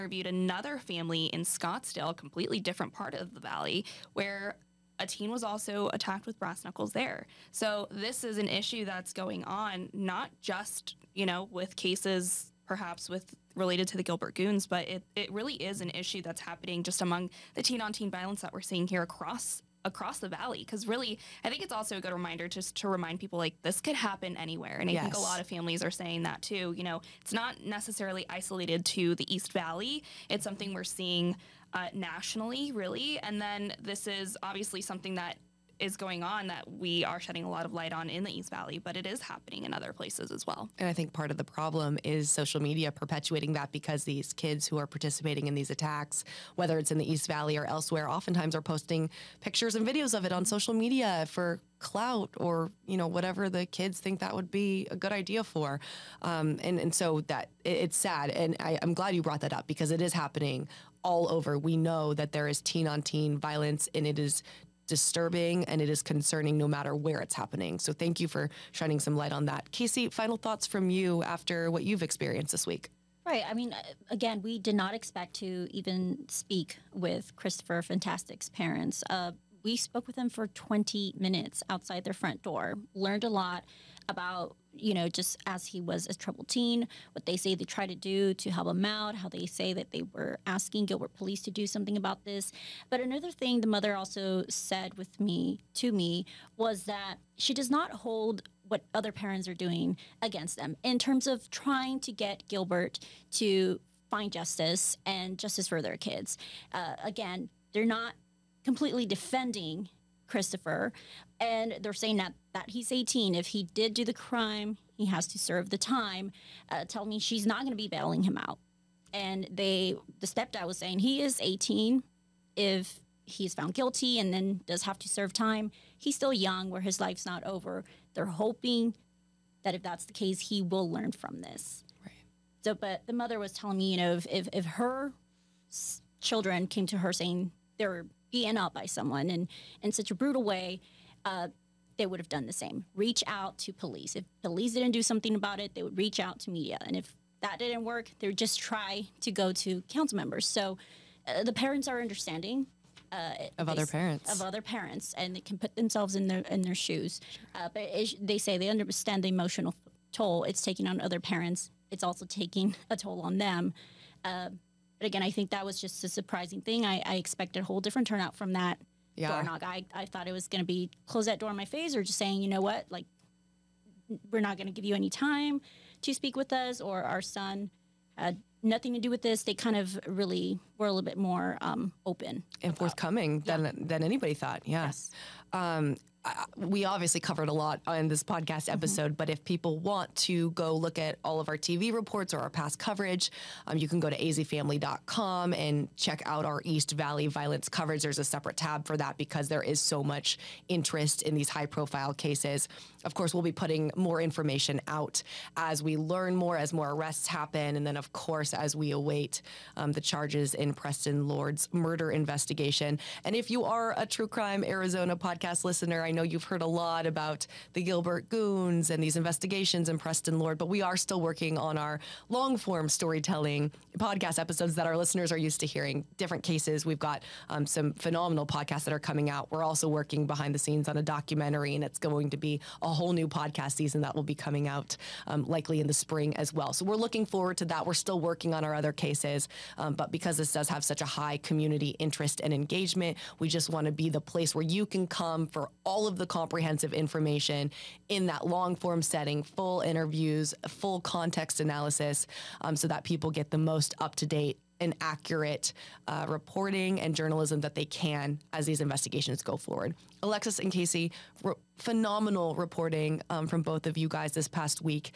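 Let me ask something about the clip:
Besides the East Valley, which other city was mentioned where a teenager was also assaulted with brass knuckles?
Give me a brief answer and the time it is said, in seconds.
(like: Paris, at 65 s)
Scottsdale, at 1 s.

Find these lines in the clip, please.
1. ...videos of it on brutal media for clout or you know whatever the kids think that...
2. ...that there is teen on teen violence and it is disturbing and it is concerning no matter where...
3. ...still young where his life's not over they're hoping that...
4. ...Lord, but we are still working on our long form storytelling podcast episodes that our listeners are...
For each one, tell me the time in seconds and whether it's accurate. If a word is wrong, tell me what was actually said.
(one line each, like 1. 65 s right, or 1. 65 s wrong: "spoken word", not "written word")
1. 49 s wrong: "social", not "brutal"
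2. 62 s right
3. 126 s right
4. 220 s right.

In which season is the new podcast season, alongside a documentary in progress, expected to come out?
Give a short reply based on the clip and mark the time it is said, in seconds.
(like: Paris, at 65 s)
Spring, at 235 s.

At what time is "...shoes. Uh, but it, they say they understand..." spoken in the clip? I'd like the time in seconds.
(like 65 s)
156 s.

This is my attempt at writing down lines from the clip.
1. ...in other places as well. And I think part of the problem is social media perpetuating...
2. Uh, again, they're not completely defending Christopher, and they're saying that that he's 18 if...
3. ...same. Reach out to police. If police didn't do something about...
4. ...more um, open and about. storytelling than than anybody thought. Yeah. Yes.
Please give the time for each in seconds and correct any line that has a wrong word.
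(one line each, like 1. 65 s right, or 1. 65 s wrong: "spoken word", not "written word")
1. 39 s right
2. 106 s right
3. 142 s right
4. 181 s wrong: "forthcoming", not "storytelling".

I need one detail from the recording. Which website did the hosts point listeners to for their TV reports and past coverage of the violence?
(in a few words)
azfamily.com.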